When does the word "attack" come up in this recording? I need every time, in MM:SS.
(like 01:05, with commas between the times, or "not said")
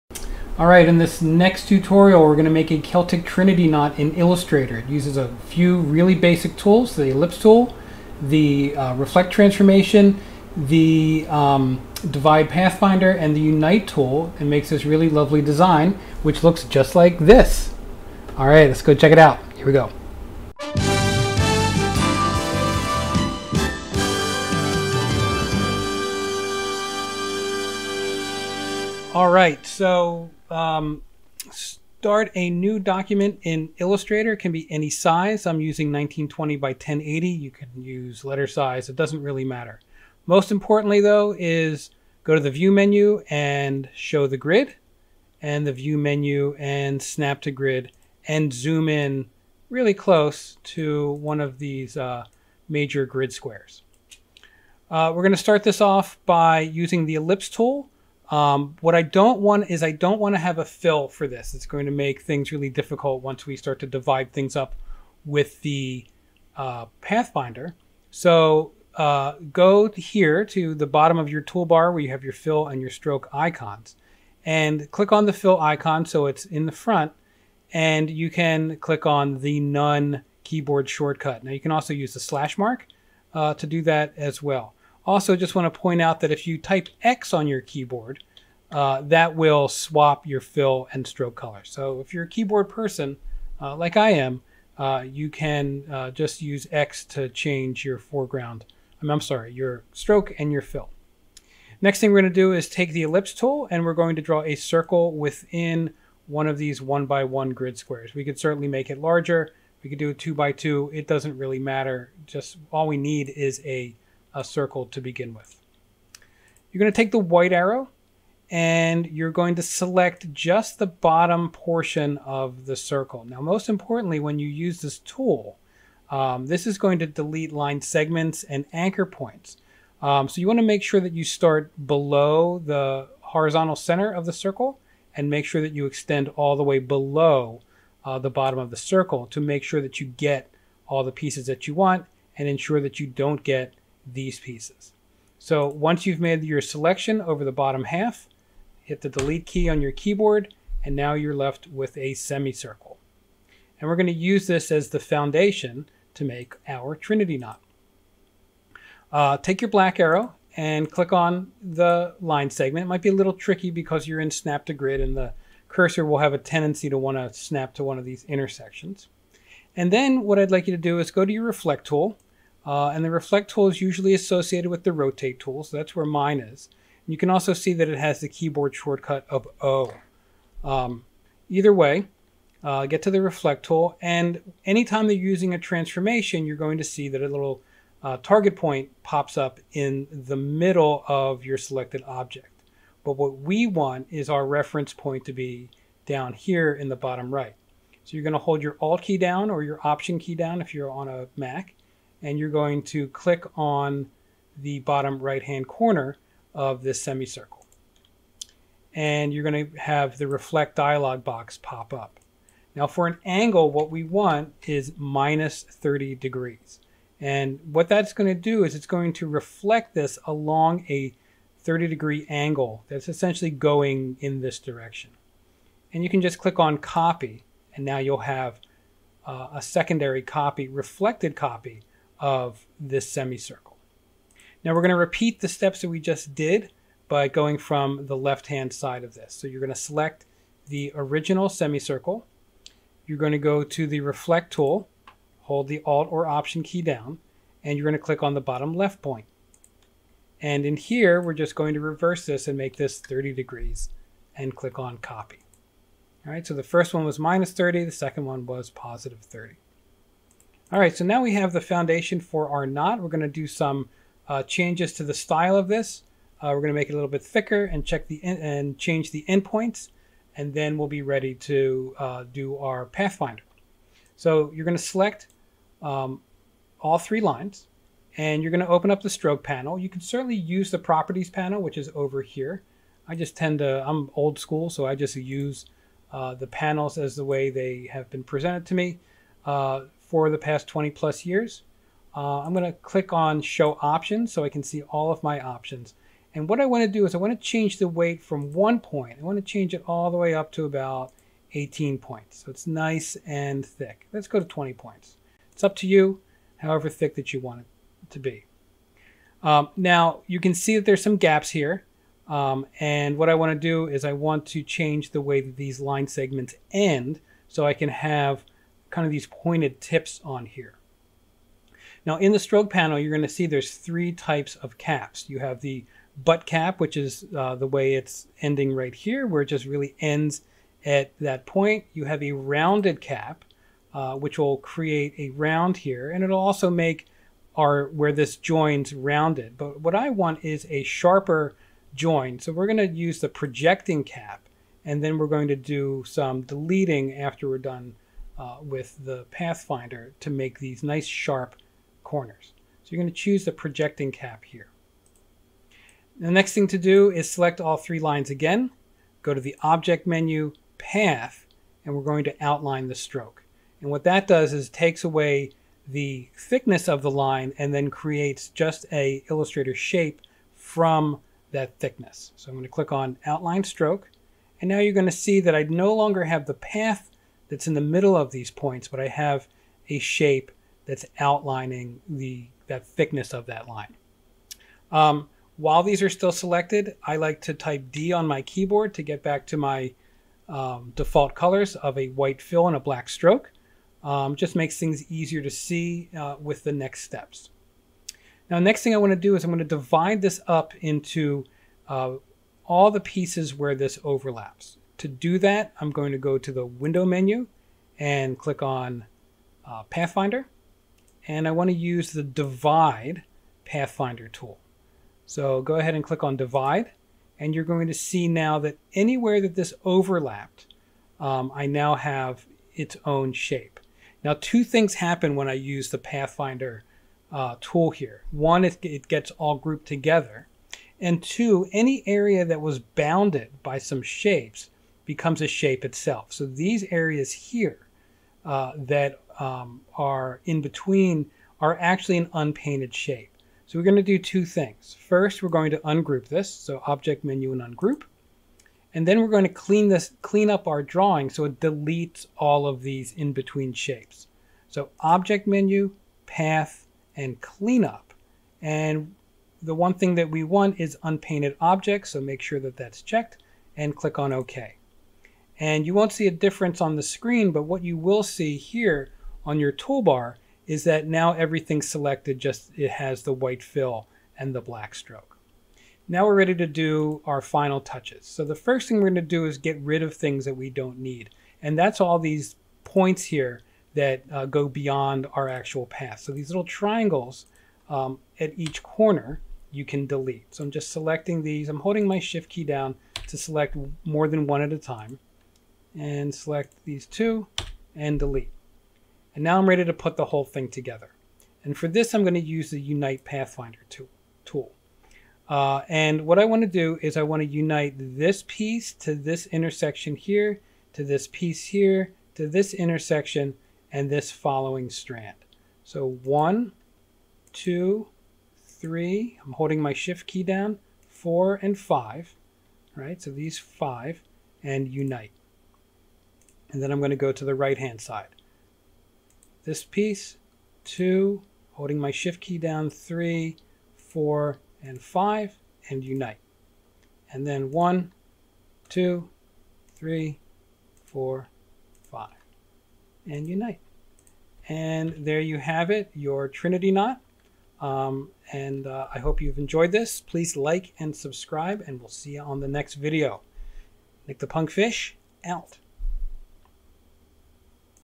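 not said.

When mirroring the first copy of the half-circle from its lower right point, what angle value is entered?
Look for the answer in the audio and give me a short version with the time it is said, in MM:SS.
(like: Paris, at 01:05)
-30 degrees, at 03:34.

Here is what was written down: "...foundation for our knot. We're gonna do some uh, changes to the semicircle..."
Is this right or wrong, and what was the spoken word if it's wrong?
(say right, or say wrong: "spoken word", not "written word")
wrong: "style", not "semicircle".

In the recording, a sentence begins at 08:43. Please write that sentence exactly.
So these five and unite and then I'm going to go to the right hand side.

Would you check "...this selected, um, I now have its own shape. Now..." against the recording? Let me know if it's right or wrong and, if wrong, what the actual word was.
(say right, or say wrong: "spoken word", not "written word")
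wrong: "overlapped", not "selected".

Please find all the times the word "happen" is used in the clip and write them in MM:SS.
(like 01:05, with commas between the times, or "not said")
07:04.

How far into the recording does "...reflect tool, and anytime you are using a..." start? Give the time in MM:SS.
03:03.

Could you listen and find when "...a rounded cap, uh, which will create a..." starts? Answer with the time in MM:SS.
05:32.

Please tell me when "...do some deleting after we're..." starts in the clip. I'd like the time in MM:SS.
05:45.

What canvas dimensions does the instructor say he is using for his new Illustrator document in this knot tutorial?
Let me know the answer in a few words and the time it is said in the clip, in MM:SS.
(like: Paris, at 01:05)
1920 by 1080, at 00:35.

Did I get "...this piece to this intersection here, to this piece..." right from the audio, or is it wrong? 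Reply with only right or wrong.
right.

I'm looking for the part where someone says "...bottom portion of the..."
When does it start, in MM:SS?
02:00.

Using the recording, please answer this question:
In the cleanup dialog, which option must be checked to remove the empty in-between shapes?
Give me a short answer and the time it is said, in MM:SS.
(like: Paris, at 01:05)
unpainted objects, at 07:41.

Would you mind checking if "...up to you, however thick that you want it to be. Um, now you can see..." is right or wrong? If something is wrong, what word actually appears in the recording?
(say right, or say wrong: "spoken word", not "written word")
right.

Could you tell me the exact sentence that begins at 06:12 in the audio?
So I'm going to click on outline stroke.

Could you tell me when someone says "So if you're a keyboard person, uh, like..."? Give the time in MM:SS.
01:31.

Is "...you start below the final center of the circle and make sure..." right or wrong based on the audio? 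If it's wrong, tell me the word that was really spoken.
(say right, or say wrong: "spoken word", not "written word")
wrong: "horizontal", not "final".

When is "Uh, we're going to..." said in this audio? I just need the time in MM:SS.
00:54.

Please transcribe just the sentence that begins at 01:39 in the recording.
i um, I'm sorry, your stroke and your fill.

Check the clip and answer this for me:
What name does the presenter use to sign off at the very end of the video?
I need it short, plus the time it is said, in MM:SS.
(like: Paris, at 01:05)
Nick the Punk Fish, at 09:14.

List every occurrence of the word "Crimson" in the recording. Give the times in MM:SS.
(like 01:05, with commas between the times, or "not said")
not said.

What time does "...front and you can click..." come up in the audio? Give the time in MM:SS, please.
01:16.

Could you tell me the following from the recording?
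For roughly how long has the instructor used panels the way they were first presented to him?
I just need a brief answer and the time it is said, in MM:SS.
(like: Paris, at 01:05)
20 plus years, at 04:50.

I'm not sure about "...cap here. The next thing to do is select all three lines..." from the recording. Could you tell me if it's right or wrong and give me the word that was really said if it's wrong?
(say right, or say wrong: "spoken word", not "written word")
right.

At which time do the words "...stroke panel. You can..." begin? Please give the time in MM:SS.
04:39.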